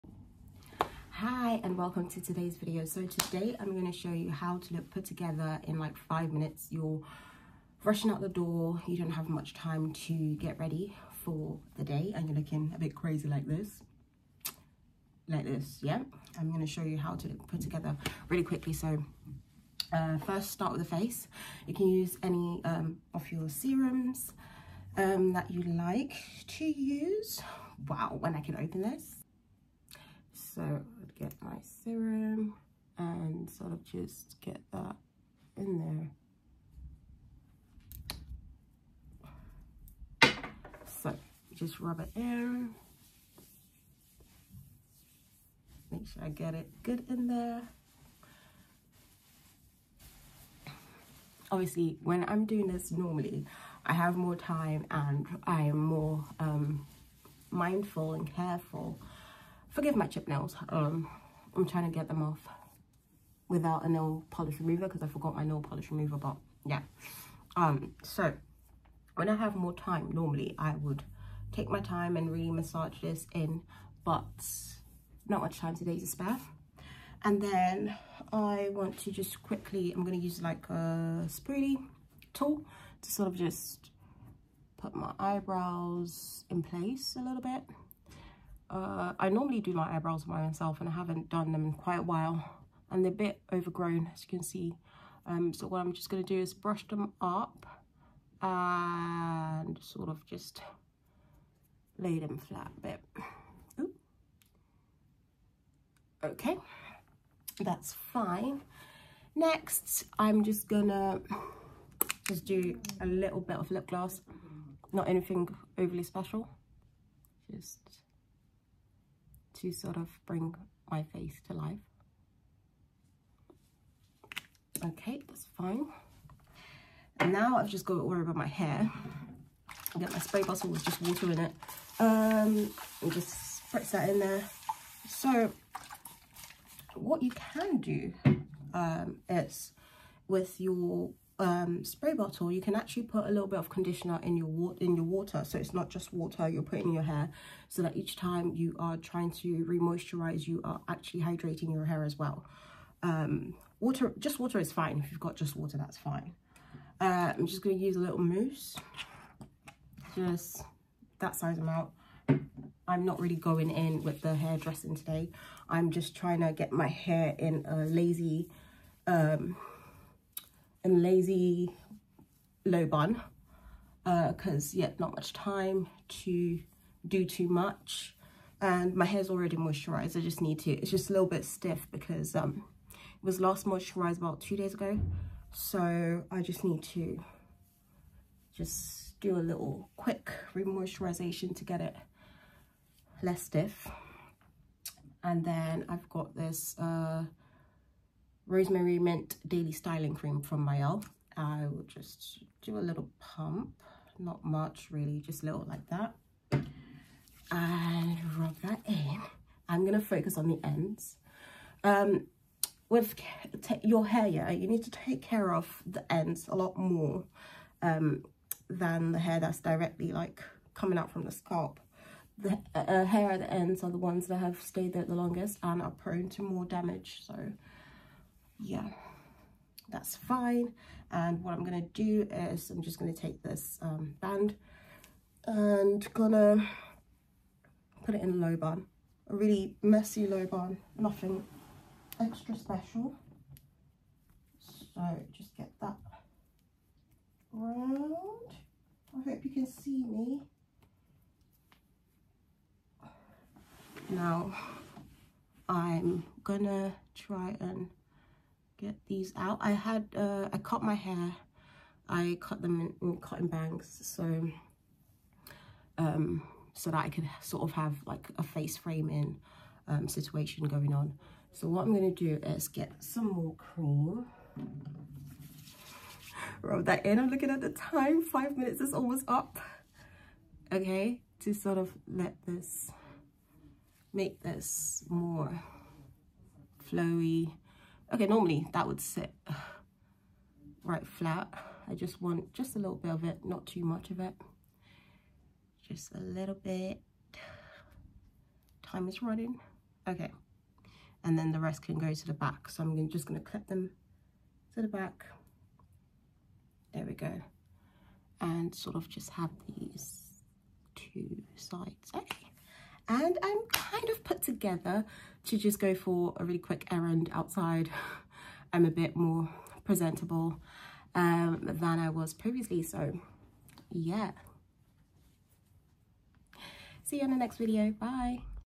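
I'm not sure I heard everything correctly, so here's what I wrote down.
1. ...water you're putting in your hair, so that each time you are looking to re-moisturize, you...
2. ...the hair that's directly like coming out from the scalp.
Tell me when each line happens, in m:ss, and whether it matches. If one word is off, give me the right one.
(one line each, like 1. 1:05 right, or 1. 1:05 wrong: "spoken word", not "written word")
1. 2:26 wrong: "trying", not "looking"
2. 3:39 right.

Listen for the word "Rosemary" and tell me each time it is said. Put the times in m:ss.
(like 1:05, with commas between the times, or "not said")
3:18.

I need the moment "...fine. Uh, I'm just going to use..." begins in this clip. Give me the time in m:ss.
2:35.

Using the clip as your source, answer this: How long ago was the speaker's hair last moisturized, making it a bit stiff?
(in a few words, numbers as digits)
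2 days ago.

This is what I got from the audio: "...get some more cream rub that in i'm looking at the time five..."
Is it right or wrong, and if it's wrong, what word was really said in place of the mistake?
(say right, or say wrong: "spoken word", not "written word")
right.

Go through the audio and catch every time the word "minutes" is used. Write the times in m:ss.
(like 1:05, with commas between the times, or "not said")
0:06, 4:38.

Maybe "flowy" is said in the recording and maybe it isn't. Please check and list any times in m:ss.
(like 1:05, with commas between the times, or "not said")
4:46.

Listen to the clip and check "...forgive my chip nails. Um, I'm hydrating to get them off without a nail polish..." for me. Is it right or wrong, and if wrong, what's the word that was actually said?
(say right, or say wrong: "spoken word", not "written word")
wrong: "trying", not "hydrating".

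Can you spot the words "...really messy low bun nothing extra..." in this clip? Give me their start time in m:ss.
3:59.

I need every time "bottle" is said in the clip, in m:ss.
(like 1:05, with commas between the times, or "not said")
2:10, 2:22.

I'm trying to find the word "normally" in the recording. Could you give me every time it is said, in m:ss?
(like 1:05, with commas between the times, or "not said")
0:52, 1:10, 1:29, 4:48.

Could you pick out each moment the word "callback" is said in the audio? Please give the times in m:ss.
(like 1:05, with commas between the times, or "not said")
not said.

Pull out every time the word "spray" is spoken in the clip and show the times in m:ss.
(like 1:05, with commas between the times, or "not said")
2:10, 2:21.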